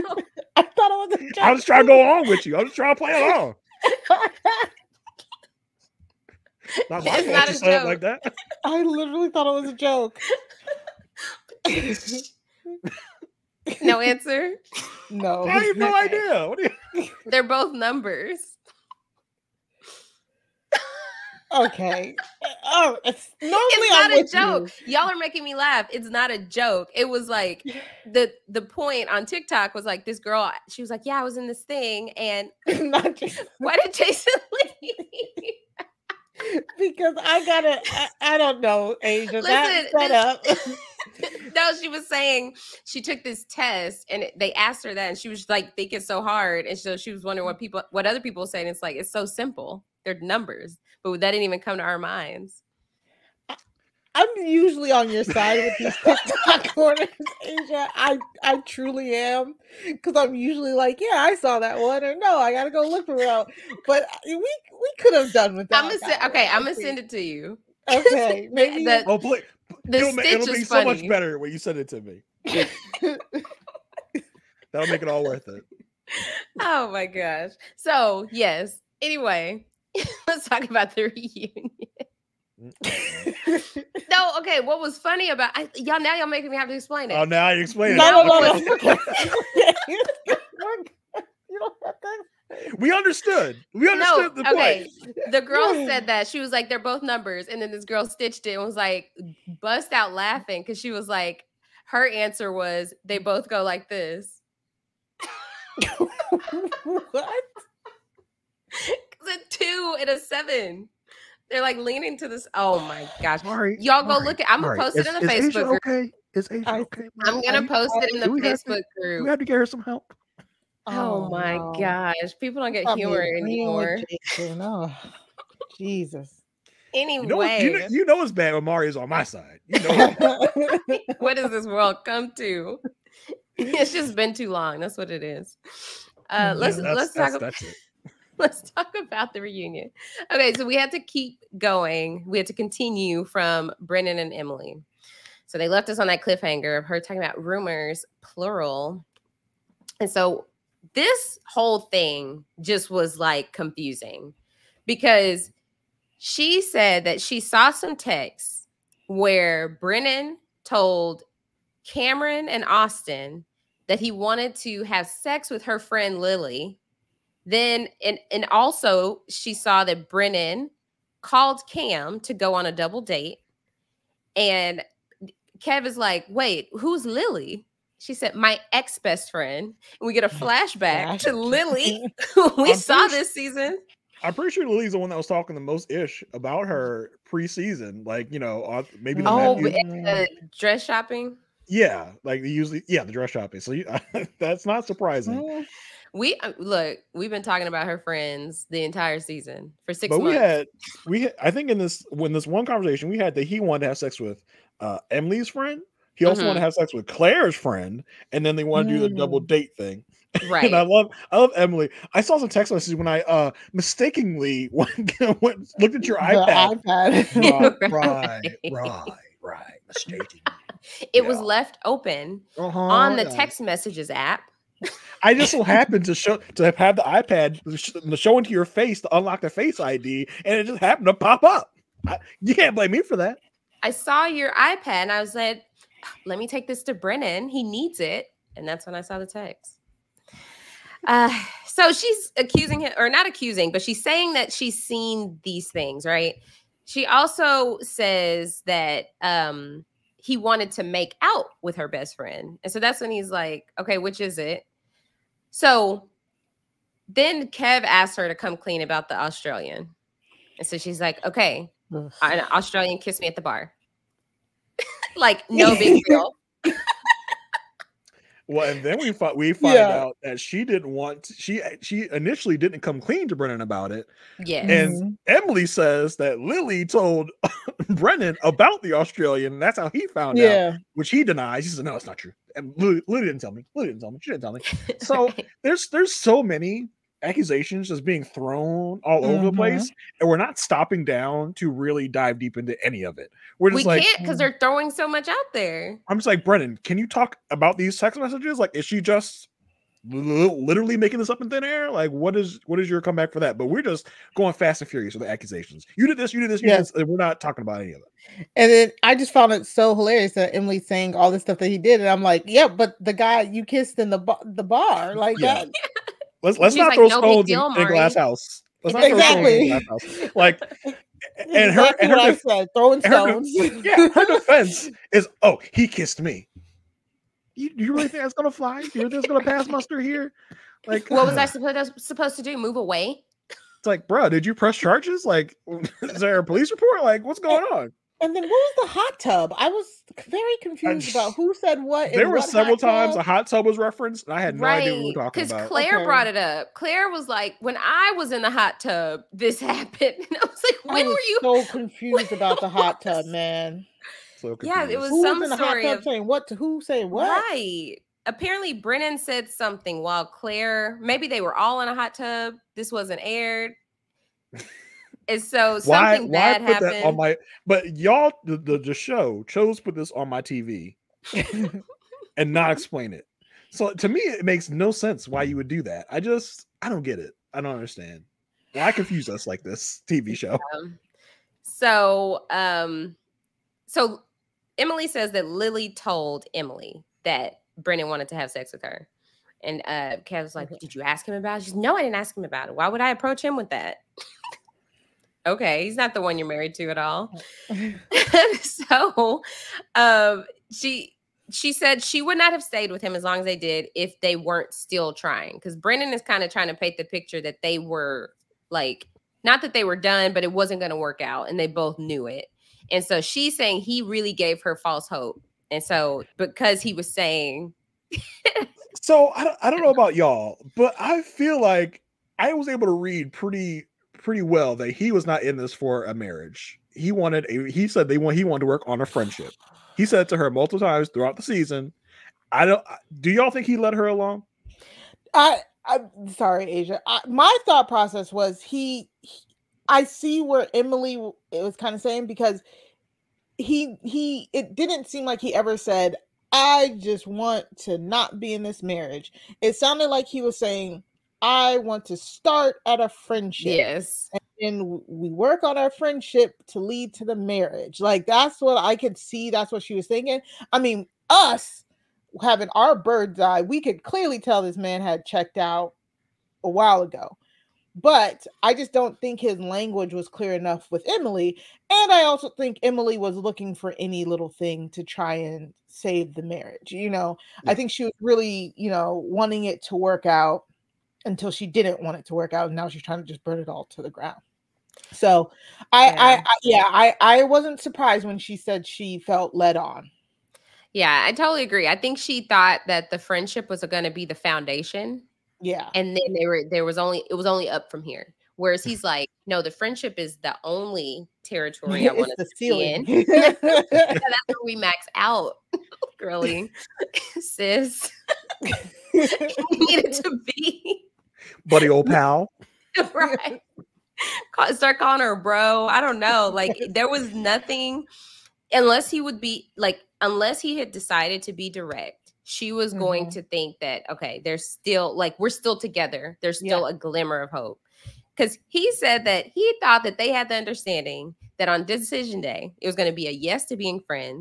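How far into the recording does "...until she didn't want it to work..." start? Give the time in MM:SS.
08:01.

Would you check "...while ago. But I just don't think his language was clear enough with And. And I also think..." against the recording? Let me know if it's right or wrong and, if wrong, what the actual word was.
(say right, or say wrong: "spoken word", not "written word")
wrong: "Emily", not "And".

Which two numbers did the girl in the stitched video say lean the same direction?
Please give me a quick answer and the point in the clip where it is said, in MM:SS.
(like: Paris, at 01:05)
2 and 7, at 01:49.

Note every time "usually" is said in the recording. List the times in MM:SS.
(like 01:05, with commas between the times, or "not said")
00:54, 01:00, 03:12.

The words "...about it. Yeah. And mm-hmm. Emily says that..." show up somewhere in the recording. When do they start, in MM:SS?
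04:33.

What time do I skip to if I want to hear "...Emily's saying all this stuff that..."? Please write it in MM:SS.
05:10.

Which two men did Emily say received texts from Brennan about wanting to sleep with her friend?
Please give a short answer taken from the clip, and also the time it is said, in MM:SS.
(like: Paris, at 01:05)
Cameron and Austin, at 02:41.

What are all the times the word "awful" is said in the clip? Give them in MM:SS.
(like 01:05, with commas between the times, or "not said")
not said.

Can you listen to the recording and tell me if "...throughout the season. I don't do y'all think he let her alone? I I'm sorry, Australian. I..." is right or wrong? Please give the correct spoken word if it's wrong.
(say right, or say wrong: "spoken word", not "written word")
wrong: "Aysha", not "Australian".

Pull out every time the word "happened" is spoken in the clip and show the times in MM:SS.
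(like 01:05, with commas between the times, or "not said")
03:45, 03:50, 05:49, 06:06.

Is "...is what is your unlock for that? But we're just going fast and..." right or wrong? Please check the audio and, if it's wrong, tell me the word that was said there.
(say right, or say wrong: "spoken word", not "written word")
wrong: "comeback", not "unlock".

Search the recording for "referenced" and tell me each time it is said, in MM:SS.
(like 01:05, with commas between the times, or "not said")
05:43.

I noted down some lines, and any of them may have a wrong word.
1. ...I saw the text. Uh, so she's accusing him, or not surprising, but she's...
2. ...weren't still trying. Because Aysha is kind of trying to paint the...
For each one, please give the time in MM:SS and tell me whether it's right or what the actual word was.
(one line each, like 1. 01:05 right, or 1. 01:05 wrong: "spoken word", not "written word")
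1. 03:58 wrong: "accusing", not "surprising"
2. 06:44 wrong: "Brennan", not "Aysha".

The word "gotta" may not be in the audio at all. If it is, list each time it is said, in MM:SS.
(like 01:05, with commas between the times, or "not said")
00:37, 01:02.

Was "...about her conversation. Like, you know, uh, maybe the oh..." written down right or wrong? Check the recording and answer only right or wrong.
wrong.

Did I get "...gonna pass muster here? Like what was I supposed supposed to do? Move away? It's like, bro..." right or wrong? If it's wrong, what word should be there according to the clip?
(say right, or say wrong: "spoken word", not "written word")
right.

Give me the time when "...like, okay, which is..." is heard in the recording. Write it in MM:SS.
04:13.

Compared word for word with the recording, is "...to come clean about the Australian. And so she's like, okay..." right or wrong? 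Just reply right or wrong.
right.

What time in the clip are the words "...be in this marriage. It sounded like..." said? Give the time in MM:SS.
07:28.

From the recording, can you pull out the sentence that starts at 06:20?
Um, so, um, so Emily says that Lily told Emily that Brennan wanted to have sex with her.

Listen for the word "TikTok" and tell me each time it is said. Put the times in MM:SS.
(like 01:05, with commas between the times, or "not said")
00:29, 00:56.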